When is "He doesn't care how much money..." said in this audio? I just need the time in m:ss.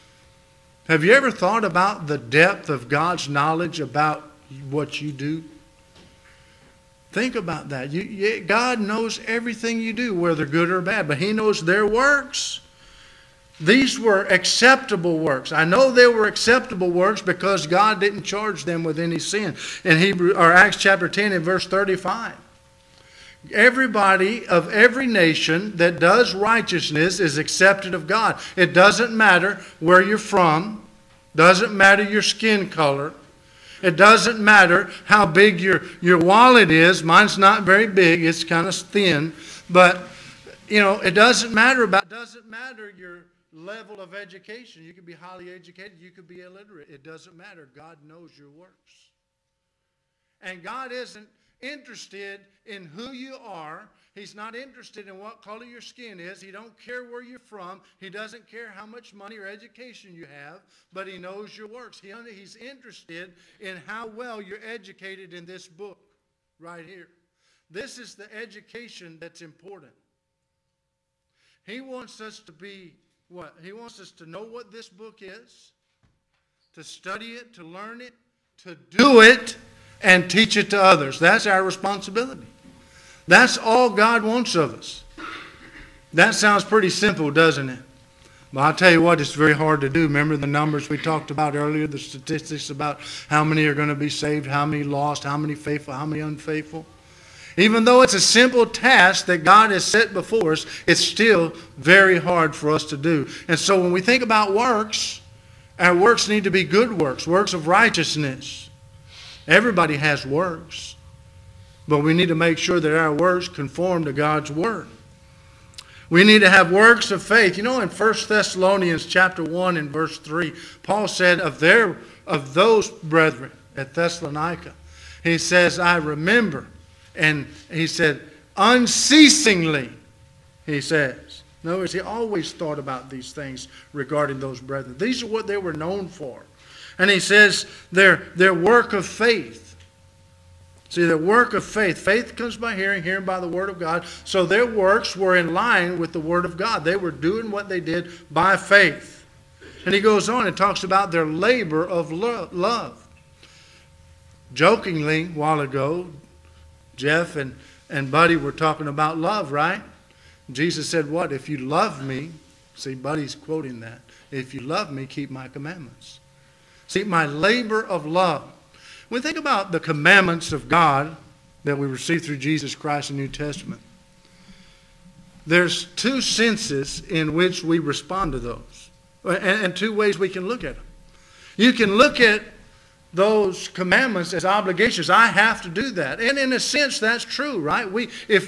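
0:57.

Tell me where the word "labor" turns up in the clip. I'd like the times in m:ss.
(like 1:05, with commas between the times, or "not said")
2:31, 2:47.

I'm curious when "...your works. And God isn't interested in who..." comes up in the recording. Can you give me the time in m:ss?
0:48.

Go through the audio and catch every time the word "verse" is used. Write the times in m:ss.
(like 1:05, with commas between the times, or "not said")
0:21, 1:59.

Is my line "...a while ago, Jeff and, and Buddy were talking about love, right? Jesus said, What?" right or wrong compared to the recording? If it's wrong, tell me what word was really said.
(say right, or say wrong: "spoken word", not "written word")
right.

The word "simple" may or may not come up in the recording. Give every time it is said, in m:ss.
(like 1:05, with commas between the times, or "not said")
1:26, 1:38.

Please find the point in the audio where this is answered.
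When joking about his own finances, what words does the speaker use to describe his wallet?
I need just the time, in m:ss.
0:38.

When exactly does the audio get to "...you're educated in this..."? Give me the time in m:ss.
1:04.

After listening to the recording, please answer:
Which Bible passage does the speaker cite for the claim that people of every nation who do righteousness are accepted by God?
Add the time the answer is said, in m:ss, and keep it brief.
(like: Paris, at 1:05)
Acts 10:35, at 0:20.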